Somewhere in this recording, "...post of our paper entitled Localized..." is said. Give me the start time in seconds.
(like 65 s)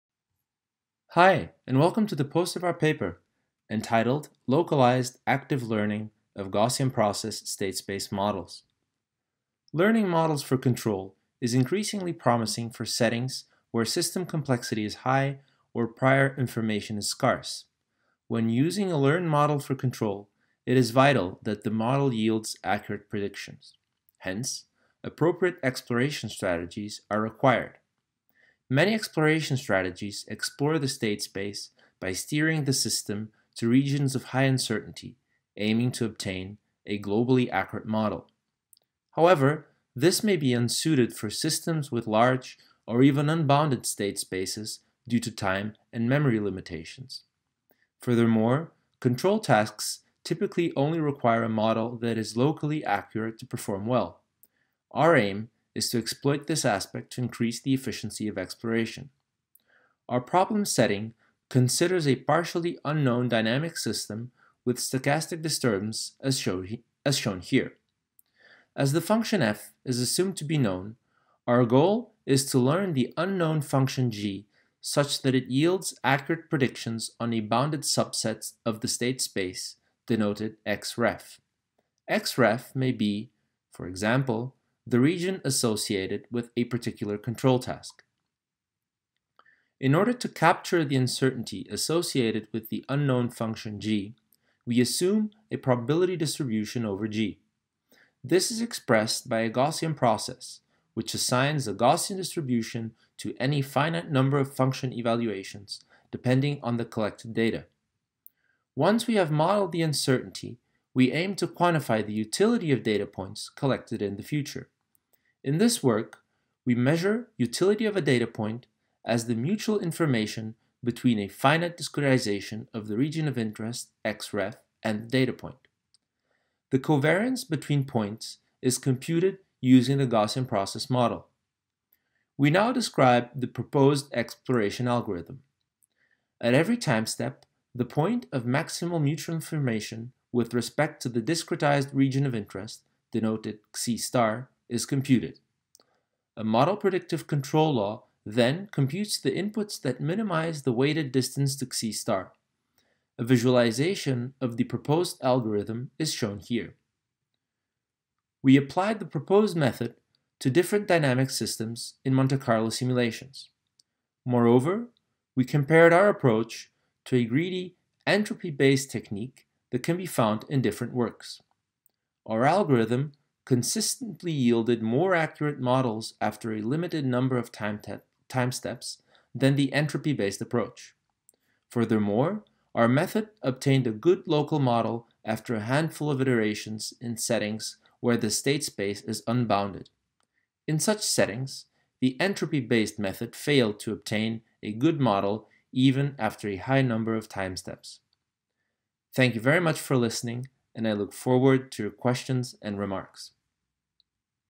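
2 s.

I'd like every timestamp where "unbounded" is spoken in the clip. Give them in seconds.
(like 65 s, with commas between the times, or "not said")
43 s, 189 s.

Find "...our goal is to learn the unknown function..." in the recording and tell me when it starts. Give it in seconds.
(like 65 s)
71 s.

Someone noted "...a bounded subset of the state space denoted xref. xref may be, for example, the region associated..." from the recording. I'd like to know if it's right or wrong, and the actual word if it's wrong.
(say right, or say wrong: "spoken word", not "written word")
right.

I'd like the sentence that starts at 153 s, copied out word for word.
A visualization of the proposed algorithm is shown here.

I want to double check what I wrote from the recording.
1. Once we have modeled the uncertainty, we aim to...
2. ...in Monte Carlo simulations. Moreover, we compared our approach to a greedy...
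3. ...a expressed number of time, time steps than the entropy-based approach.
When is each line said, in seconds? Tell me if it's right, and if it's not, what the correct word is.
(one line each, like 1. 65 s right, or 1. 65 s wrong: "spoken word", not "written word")
1. 108 s right
2. 162 s right
3. 176 s wrong: "limited", not "expressed".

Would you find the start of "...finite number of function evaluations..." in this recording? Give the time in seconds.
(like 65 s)
103 s.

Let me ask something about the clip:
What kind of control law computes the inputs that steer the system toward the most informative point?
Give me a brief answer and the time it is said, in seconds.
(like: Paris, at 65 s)
model predictive control, at 146 s.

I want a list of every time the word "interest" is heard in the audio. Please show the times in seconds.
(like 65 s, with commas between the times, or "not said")
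123 s, 142 s.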